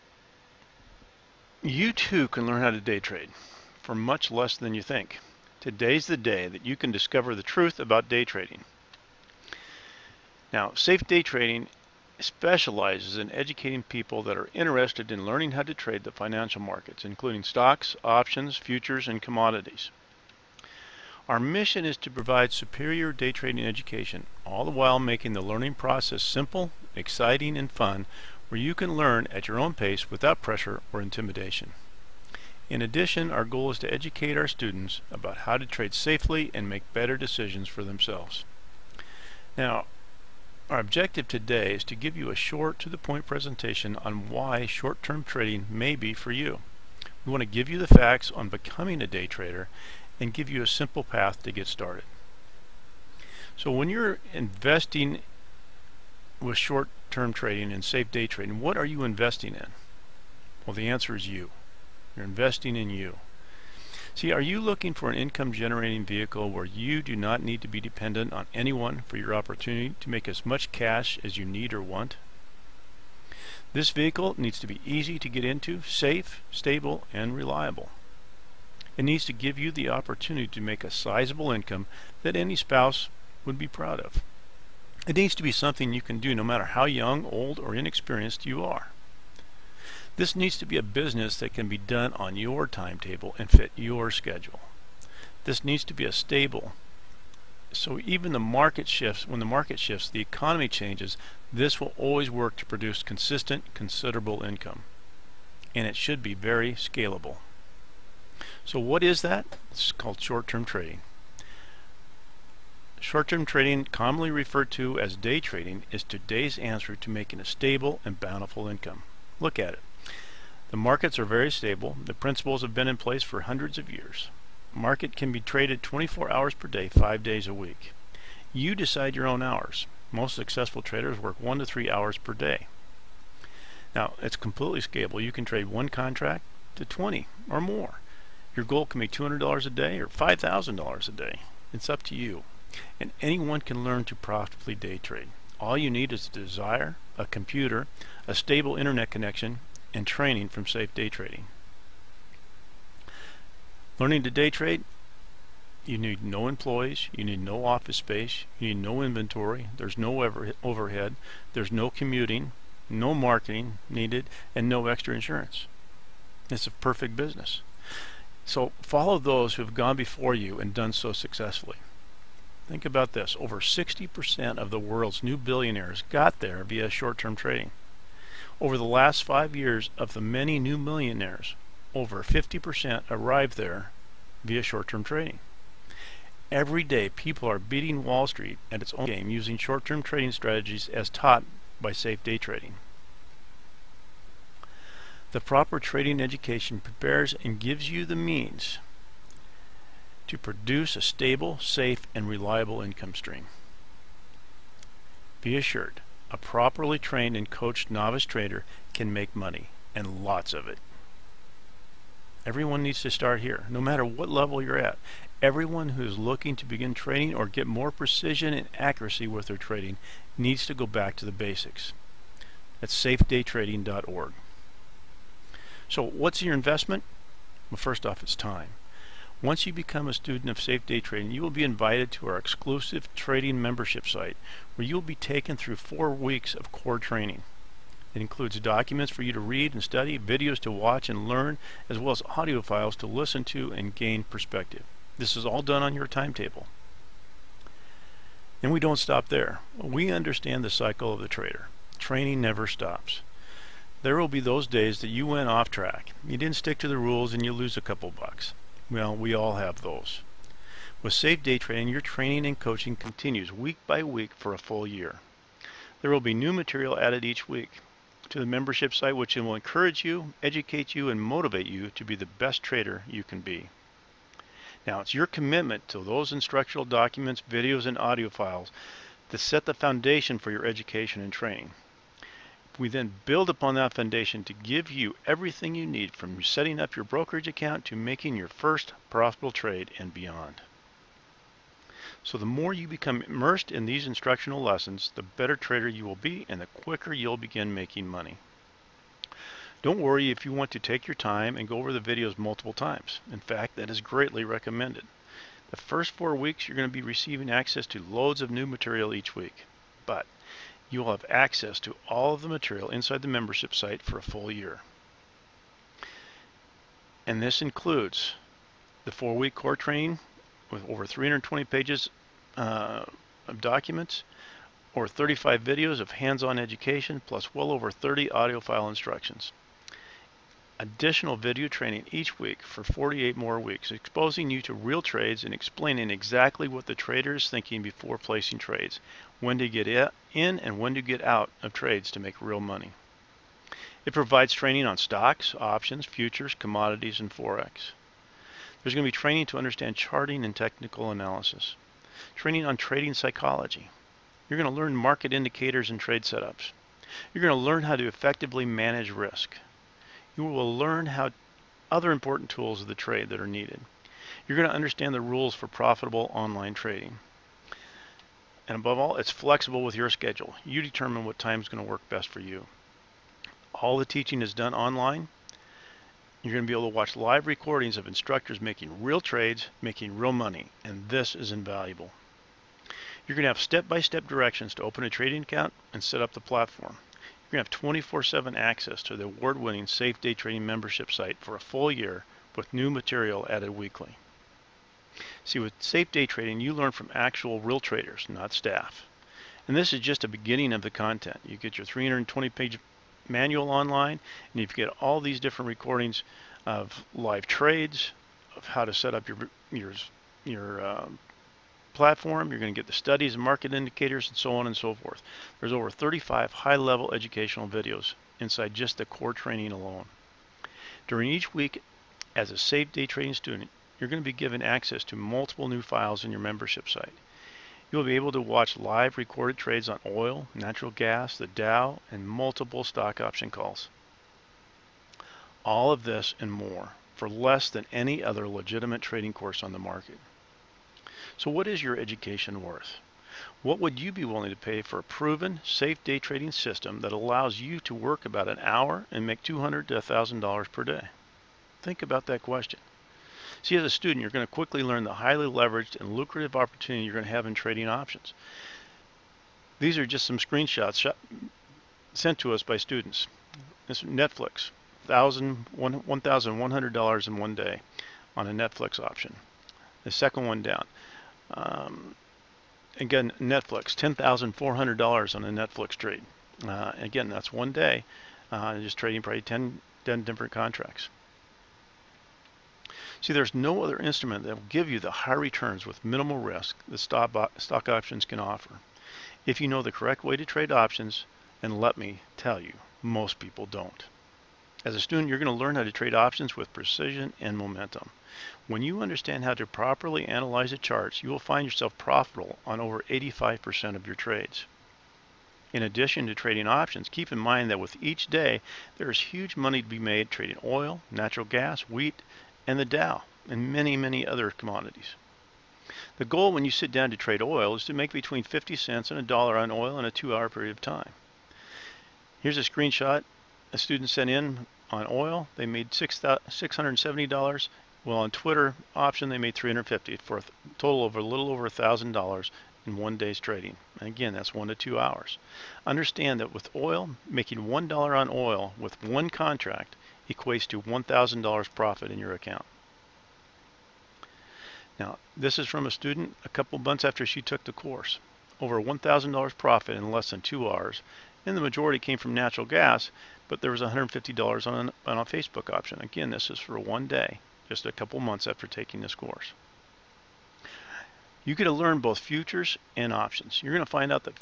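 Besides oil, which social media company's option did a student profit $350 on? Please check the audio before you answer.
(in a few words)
Twitter.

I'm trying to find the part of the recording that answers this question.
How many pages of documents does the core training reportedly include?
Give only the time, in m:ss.
5:20.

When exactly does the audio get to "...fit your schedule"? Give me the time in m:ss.
1:33.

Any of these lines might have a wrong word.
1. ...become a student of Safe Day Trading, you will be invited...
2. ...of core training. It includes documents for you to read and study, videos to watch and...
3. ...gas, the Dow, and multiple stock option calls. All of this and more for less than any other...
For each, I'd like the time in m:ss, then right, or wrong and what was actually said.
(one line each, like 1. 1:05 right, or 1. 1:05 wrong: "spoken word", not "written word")
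1. 3:49 right
2. 3:56 right
3. 7:10 right.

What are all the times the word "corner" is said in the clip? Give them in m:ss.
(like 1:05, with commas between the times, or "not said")
not said.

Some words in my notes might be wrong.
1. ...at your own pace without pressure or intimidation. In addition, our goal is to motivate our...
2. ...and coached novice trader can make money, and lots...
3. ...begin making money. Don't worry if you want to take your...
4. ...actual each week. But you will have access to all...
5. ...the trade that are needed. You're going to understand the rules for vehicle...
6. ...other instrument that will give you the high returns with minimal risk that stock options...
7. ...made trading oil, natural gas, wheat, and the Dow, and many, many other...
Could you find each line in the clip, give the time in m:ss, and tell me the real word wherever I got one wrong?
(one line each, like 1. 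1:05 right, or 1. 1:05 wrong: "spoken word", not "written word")
1. 0:29 wrong: "educate", not "motivate"
2. 3:27 right
3. 4:57 right
4. 5:08 wrong: "material", not "actual"
5. 6:02 wrong: "profitable", not "vehicle"
6. 8:03 right
7. 8:29 right.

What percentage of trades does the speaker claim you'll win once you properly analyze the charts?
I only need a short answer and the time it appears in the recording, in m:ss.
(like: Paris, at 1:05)
Over 85%, at 8:22.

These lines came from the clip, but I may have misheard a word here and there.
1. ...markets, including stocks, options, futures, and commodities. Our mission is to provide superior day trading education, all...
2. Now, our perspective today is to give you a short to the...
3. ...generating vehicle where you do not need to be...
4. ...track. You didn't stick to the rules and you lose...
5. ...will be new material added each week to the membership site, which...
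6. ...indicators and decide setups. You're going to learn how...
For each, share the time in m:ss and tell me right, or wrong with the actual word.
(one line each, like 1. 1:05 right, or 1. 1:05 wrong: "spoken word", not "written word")
1. 0:16 right
2. 0:39 wrong: "objective", not "perspective"
3. 1:05 right
4. 4:15 right
5. 4:26 right
6. 5:55 wrong: "trade", not "decide".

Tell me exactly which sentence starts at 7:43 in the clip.
This Netflix, $1,100 in one day on a Netflix option.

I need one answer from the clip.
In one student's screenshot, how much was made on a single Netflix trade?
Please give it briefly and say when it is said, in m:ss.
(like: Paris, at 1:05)
$10,400, at 7:53.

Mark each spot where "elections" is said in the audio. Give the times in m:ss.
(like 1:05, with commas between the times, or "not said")
not said.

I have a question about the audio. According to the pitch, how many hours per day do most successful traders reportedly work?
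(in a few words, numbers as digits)
1 to 3 hours.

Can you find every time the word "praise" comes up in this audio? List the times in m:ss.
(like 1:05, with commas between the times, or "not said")
not said.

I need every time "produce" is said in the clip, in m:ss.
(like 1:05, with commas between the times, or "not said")
1:42, 3:20.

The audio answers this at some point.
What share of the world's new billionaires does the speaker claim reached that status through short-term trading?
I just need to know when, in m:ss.
2:53.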